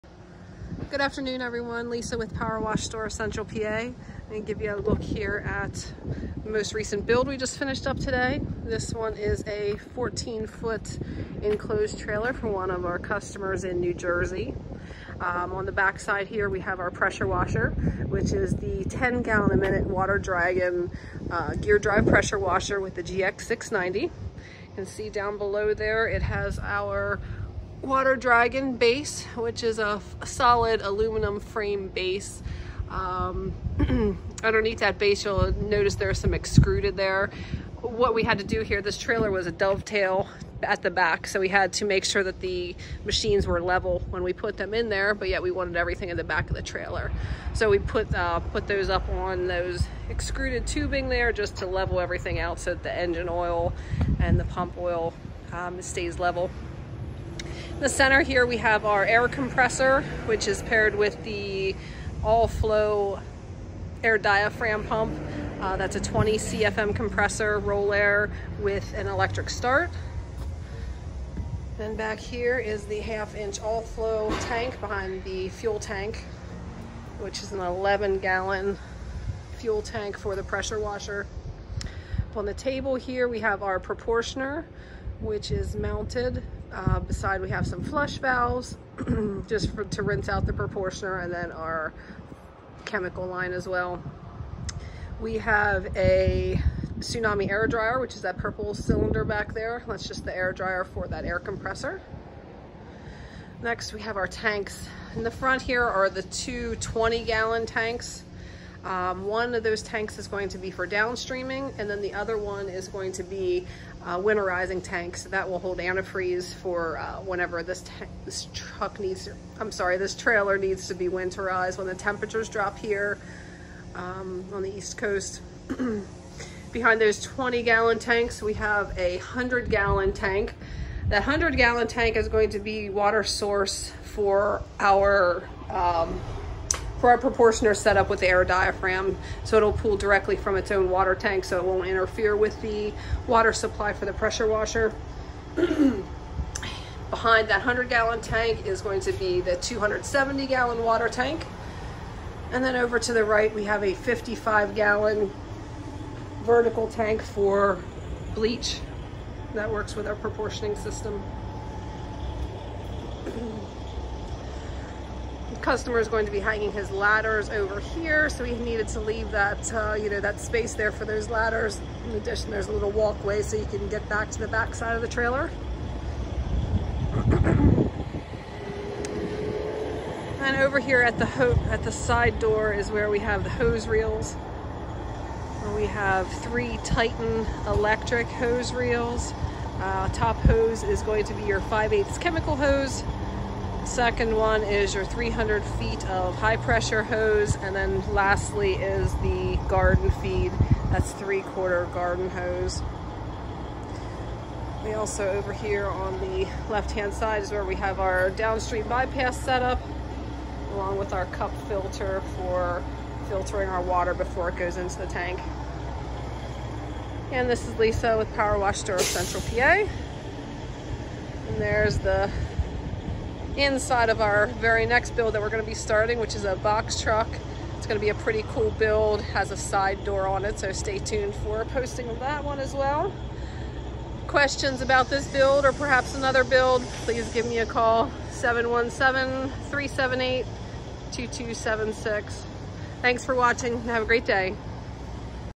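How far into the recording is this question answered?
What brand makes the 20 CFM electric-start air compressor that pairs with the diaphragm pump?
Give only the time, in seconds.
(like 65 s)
67 s.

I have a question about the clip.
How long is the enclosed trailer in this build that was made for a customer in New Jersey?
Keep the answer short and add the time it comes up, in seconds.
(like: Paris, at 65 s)
14 foot, at 9 s.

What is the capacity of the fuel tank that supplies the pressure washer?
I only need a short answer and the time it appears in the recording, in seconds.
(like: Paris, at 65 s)
11 gallon, at 77 s.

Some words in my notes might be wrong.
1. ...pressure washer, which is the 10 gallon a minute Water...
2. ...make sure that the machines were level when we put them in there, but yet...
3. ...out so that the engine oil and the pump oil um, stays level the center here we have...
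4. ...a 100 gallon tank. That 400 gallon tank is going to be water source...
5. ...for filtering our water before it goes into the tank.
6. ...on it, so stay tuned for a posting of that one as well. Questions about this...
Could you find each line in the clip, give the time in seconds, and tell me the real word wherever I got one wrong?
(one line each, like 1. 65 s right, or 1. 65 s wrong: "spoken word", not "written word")
1. 16 s right
2. 41 s right
3. 52 s right
4. 128 s wrong: "100", not "400"
5. 212 s right
6. 230 s right.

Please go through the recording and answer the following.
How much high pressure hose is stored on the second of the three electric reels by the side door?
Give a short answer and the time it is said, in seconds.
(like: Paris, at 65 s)
300 feet, at 195 s.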